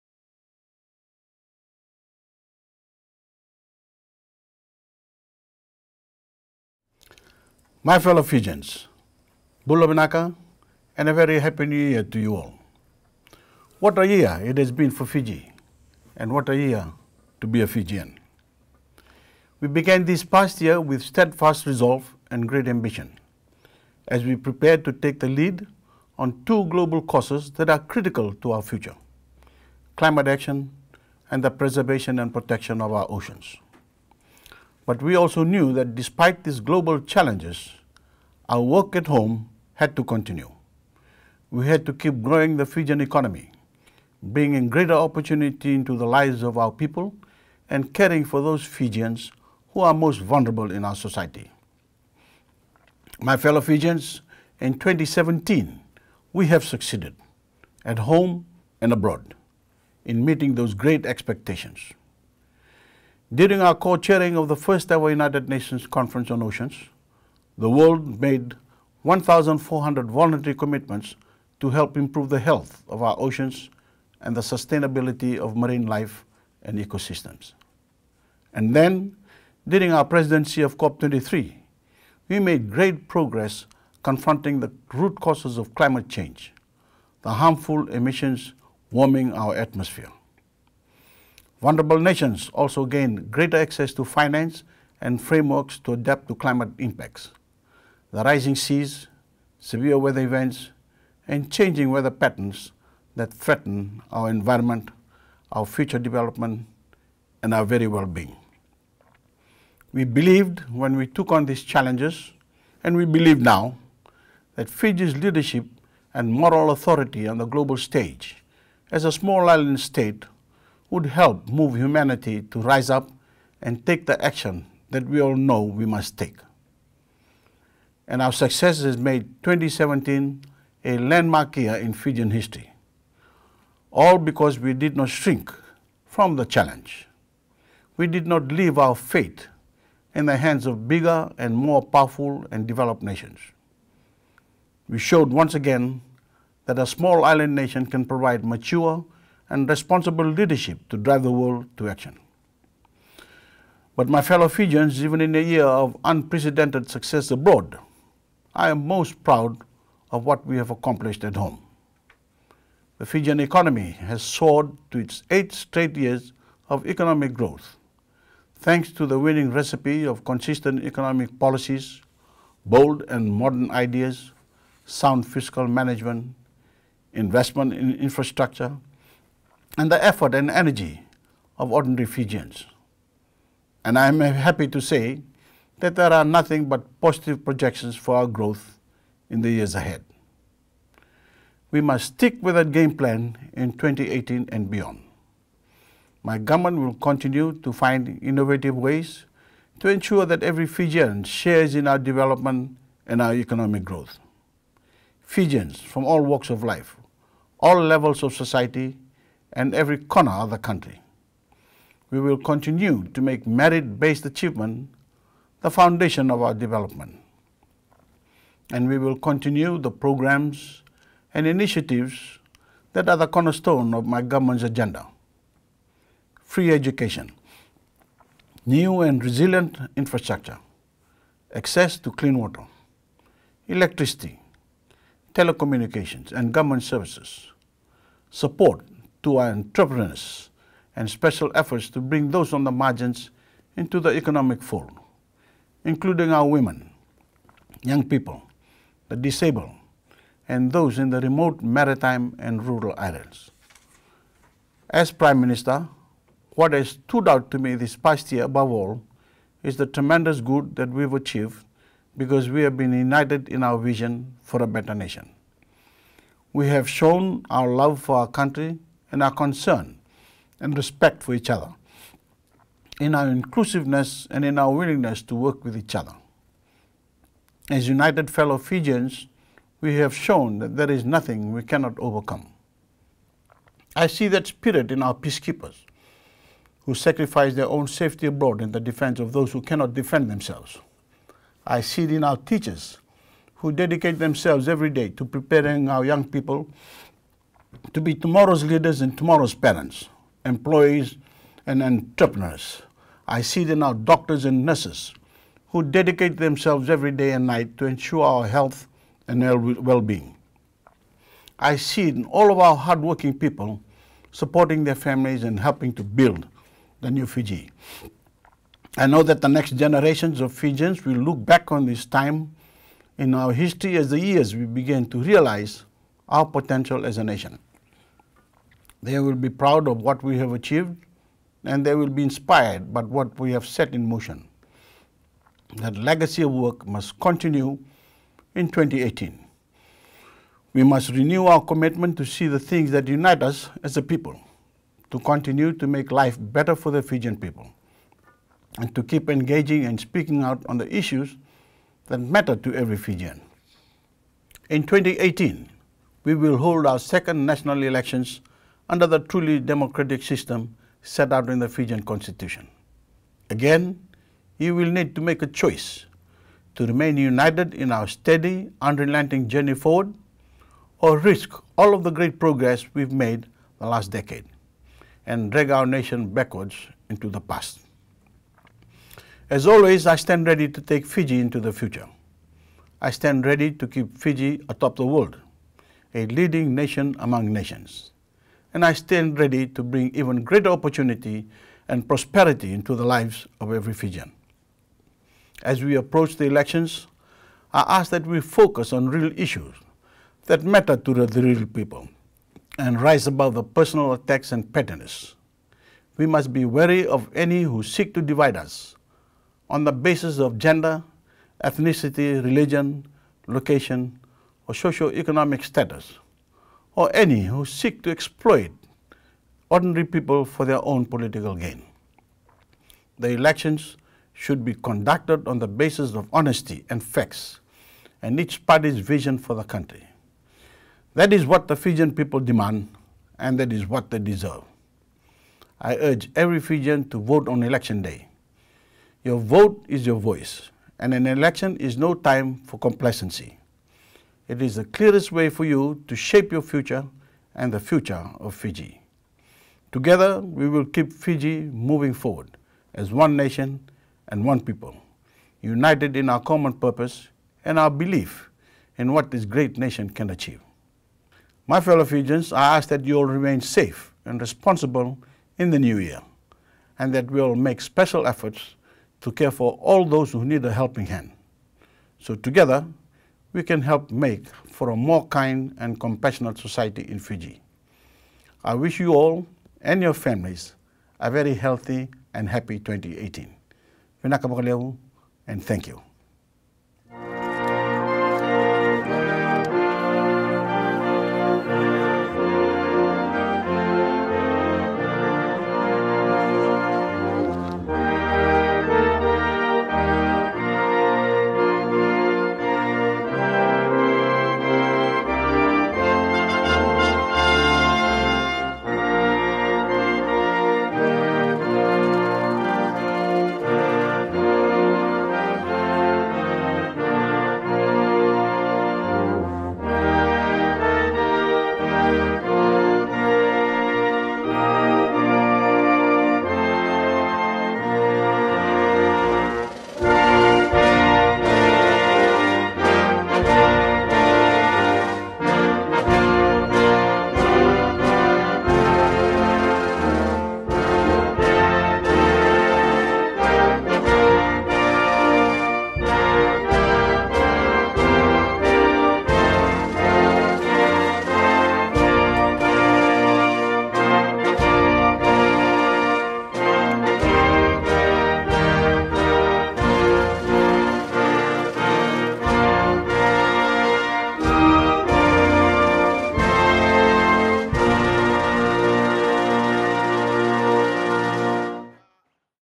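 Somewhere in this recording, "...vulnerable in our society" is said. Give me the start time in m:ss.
0:50.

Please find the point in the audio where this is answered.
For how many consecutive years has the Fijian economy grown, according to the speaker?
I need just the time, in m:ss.
2:45.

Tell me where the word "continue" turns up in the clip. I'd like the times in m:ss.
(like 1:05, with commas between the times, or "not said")
0:40, 3:16, 3:32, 3:39, 5:37, 5:45.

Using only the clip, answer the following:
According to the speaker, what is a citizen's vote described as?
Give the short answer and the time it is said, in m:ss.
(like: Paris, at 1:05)
Your voice, at 7:20.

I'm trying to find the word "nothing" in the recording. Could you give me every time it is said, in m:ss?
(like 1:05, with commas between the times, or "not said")
3:06, 4:41.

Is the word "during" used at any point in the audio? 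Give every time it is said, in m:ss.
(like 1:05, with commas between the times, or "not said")
1:03, 1:19.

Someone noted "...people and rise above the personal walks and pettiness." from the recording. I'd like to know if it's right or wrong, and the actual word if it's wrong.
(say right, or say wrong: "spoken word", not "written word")
wrong: "attacks", not "walks".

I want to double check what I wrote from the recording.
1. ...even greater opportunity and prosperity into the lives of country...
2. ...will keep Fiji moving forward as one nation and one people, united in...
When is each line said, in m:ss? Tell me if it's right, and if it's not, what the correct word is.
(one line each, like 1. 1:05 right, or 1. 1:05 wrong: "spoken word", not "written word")
1. 6:30 wrong: "every", not "country"
2. 7:30 right.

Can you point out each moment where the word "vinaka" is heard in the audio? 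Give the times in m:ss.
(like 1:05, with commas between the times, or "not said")
0:09, 8:04.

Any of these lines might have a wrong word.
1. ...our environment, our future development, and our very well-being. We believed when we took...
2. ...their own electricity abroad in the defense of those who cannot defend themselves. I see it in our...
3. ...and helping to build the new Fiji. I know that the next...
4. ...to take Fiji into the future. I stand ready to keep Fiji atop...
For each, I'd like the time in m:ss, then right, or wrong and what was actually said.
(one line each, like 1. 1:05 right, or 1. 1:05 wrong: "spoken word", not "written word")
1. 1:44 right
2. 4:47 wrong: "safety", not "electricity"
3. 5:15 right
4. 6:20 right.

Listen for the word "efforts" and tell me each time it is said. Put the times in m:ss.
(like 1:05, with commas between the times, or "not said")
3:00, 4:01, 7:48.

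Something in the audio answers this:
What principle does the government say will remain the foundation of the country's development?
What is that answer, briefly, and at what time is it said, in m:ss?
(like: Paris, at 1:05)
Merit-based achievement, at 3:33.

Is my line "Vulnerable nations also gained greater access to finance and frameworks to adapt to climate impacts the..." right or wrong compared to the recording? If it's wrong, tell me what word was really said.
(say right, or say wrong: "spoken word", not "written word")
right.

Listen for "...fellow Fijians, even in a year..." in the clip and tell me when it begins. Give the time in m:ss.
2:34.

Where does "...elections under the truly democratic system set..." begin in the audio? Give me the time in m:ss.
5:57.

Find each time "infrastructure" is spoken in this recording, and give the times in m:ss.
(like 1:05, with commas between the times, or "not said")
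2:57, 3:49.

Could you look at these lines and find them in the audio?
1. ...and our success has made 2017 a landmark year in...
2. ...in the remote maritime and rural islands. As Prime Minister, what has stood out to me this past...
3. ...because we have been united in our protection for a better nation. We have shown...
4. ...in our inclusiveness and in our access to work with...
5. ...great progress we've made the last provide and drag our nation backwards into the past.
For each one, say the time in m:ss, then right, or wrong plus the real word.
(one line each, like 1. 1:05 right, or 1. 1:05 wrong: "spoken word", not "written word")
1. 2:08 right
2. 4:10 right
3. 4:22 wrong: "vision", not "protection"
4. 4:33 wrong: "willingness", not "access"
5. 6:12 wrong: "decade", not "provide".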